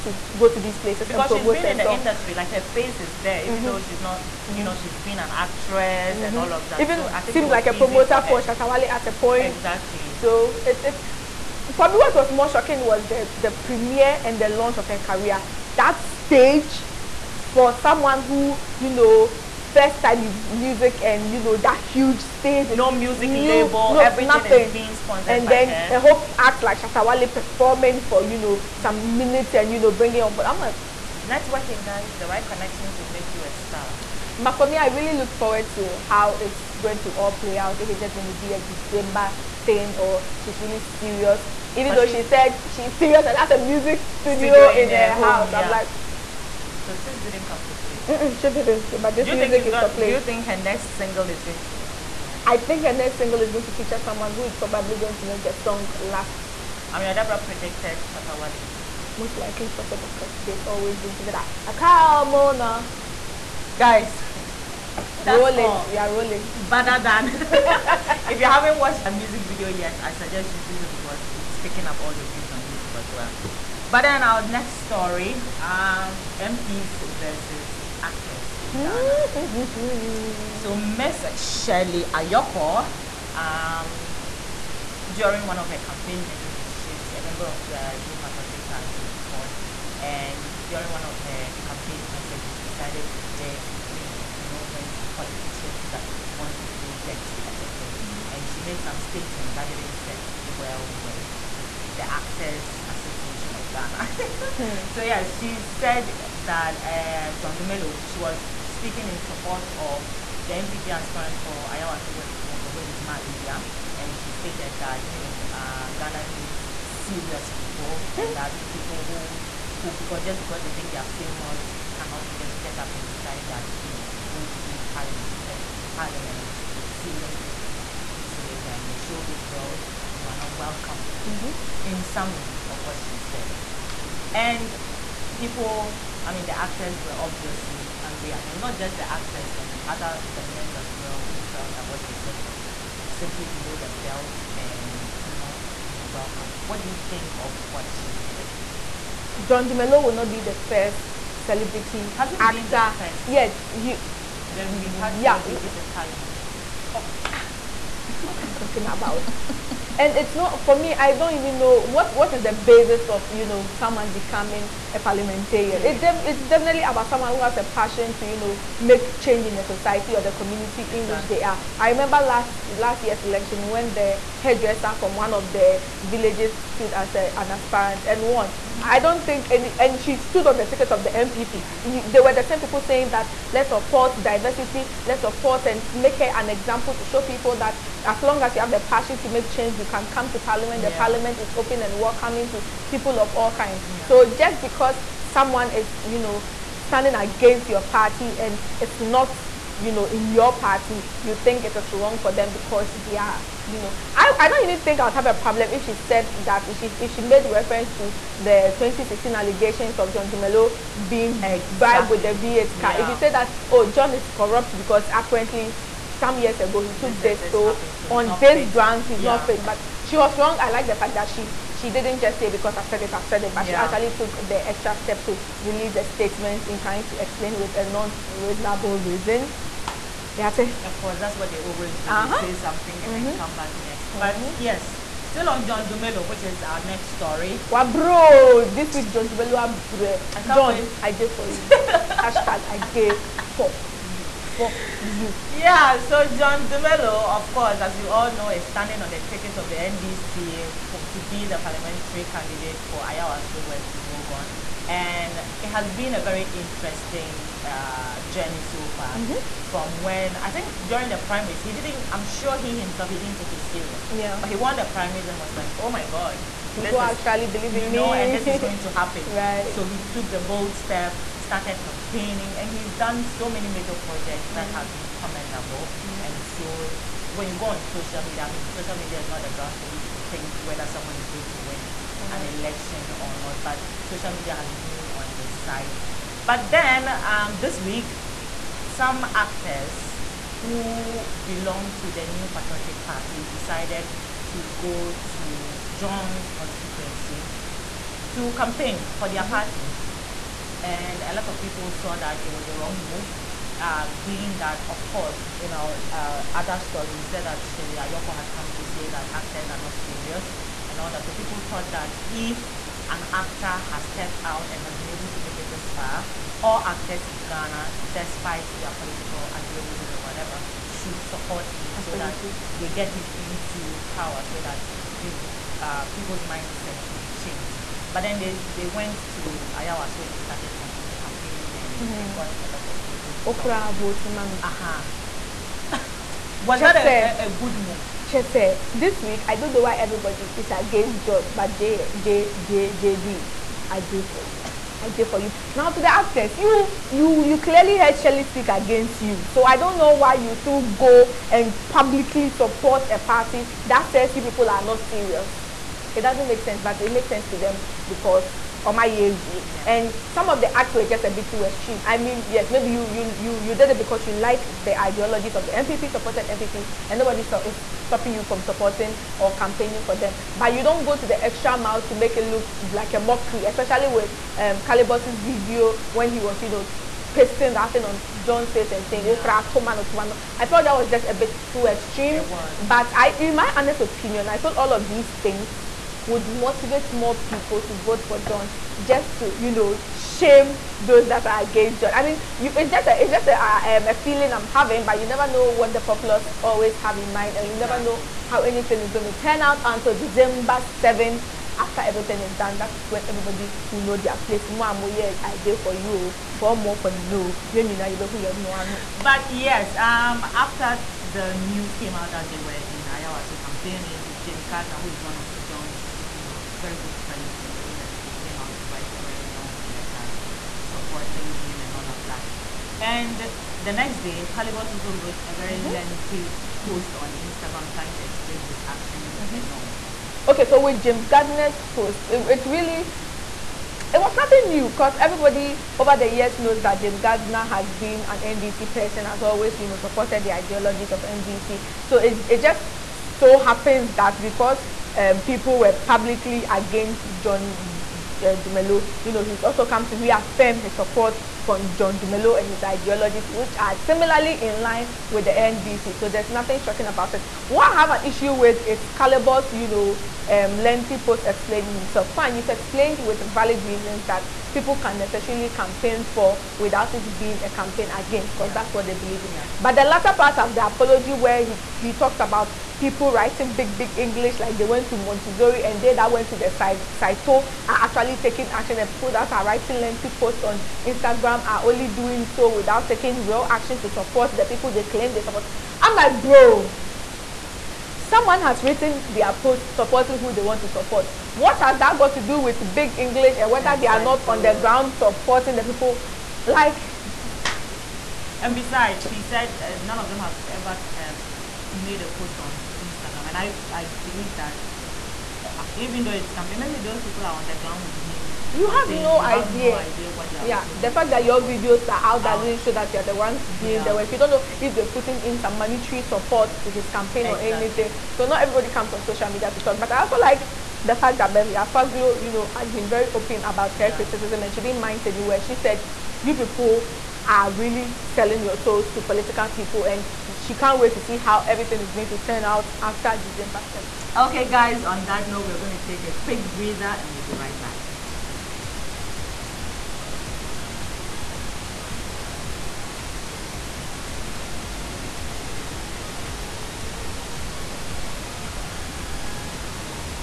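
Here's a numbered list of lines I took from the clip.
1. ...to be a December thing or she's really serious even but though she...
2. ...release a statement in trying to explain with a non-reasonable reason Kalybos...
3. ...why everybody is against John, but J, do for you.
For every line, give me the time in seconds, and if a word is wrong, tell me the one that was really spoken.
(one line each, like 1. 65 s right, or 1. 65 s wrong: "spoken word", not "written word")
1. 38 s right
2. 225 s wrong: "Yeah", not "Kalybos"
3. 339 s right.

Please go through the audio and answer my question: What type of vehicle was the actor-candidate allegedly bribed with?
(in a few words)
V8.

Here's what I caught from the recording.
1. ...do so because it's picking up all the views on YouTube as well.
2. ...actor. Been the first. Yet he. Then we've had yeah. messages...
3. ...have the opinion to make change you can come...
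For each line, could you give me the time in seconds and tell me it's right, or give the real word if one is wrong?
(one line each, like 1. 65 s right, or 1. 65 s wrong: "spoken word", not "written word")
1. 70 s right
2. 152 s wrong: "celebrities", not "messages"
3. 188 s wrong: "passion", not "opinion".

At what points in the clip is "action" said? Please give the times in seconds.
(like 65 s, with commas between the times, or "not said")
428 s, 478 s, 483 s.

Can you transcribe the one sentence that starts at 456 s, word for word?
So there's nothing shocking about it.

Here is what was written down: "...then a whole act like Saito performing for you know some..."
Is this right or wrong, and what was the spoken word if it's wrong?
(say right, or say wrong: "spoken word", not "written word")
wrong: "Shatawale", not "Saito".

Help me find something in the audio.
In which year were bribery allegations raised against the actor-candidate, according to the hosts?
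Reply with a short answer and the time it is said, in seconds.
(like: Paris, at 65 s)
2016, at 208 s.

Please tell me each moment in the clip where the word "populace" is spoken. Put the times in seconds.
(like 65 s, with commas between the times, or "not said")
396 s.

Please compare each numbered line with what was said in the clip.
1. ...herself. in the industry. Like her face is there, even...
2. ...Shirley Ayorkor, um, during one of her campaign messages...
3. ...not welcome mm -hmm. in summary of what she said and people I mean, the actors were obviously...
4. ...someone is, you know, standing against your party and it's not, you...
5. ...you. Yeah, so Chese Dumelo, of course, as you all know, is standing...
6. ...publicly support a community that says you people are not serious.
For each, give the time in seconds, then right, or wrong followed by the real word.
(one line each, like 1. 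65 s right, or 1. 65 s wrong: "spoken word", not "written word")
1. 1 s right
2. 81 s right
3. 130 s right
4. 195 s right
5. 245 s wrong: "John", not "Chese"
6. 351 s wrong: "party", not "community".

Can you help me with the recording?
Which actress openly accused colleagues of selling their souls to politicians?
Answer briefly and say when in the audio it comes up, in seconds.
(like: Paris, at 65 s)
Beverly Afaglo, at 521 s.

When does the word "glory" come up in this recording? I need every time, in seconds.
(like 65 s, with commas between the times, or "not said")
not said.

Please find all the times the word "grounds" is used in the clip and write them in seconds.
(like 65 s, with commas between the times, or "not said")
218 s, 279 s, 494 s, 507 s.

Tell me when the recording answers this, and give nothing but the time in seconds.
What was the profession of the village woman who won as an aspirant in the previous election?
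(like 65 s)
174 s.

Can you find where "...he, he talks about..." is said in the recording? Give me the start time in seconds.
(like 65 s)
471 s.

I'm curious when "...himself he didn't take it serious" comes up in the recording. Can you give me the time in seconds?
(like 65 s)
262 s.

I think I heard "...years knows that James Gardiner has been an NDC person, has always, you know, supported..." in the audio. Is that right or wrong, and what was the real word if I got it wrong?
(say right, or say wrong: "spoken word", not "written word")
right.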